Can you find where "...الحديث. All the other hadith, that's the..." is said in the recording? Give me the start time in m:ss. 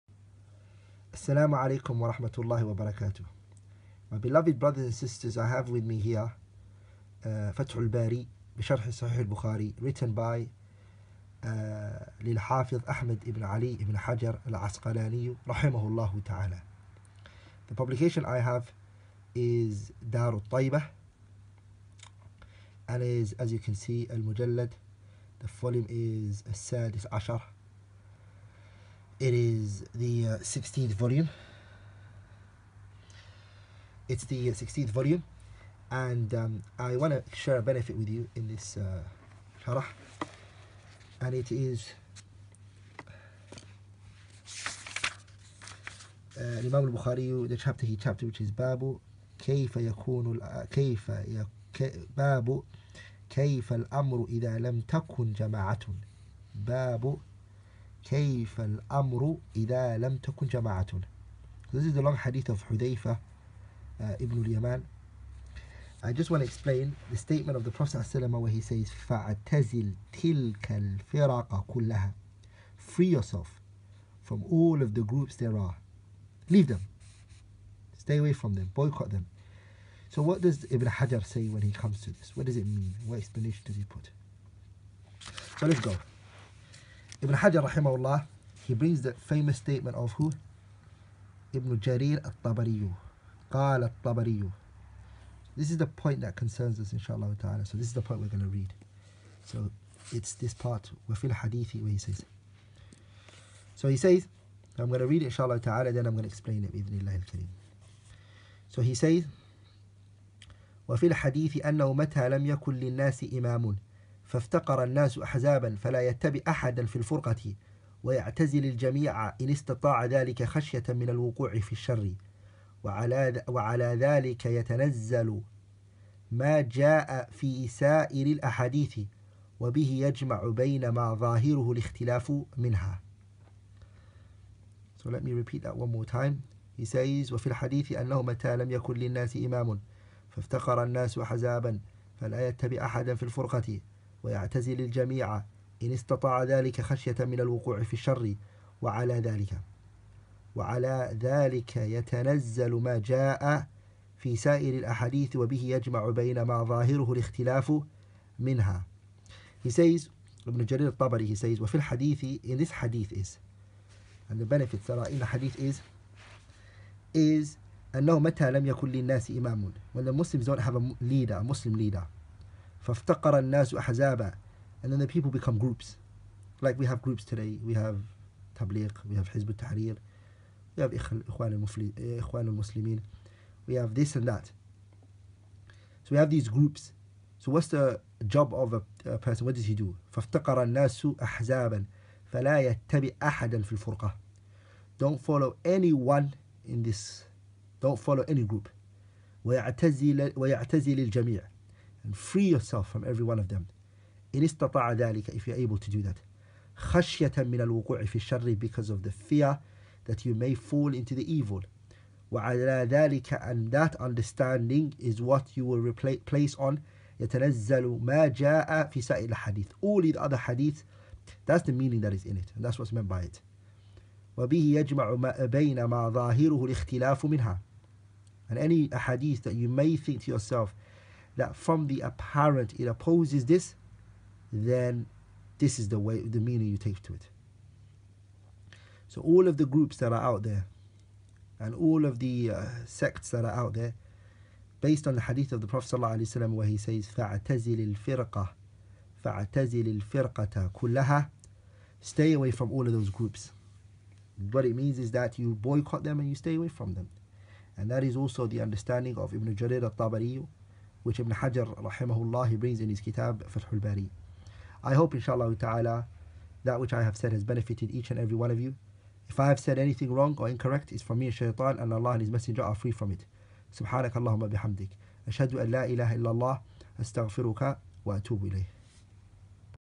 3:39.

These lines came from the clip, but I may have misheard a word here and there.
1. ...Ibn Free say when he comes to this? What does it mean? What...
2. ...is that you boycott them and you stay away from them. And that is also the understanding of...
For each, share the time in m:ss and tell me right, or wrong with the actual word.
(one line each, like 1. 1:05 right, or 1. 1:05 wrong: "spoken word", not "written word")
1. 1:20 wrong: "Hajar", not "Free"
2. 4:14 right.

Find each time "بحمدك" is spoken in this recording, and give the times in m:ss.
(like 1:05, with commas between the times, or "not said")
4:34.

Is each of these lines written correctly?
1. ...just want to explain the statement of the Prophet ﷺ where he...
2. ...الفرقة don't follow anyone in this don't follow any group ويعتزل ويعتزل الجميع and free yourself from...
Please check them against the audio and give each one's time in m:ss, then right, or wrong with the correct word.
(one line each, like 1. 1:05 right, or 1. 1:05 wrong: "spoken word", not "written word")
1. 1:06 right
2. 3:13 right.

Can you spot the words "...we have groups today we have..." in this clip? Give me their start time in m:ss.
2:56.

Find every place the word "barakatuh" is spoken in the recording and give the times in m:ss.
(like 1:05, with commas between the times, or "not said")
0:02.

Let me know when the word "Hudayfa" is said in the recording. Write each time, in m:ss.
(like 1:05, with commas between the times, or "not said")
1:02.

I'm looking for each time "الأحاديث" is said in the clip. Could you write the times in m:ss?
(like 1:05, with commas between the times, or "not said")
2:08, 2:34.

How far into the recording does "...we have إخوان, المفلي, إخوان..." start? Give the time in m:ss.
3:00.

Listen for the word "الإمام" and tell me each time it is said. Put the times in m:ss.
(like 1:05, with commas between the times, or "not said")
0:46.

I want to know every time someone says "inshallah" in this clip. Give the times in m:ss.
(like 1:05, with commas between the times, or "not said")
1:36, 1:45, 4:25.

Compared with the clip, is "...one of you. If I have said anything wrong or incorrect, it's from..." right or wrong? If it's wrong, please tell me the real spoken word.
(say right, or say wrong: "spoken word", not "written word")
right.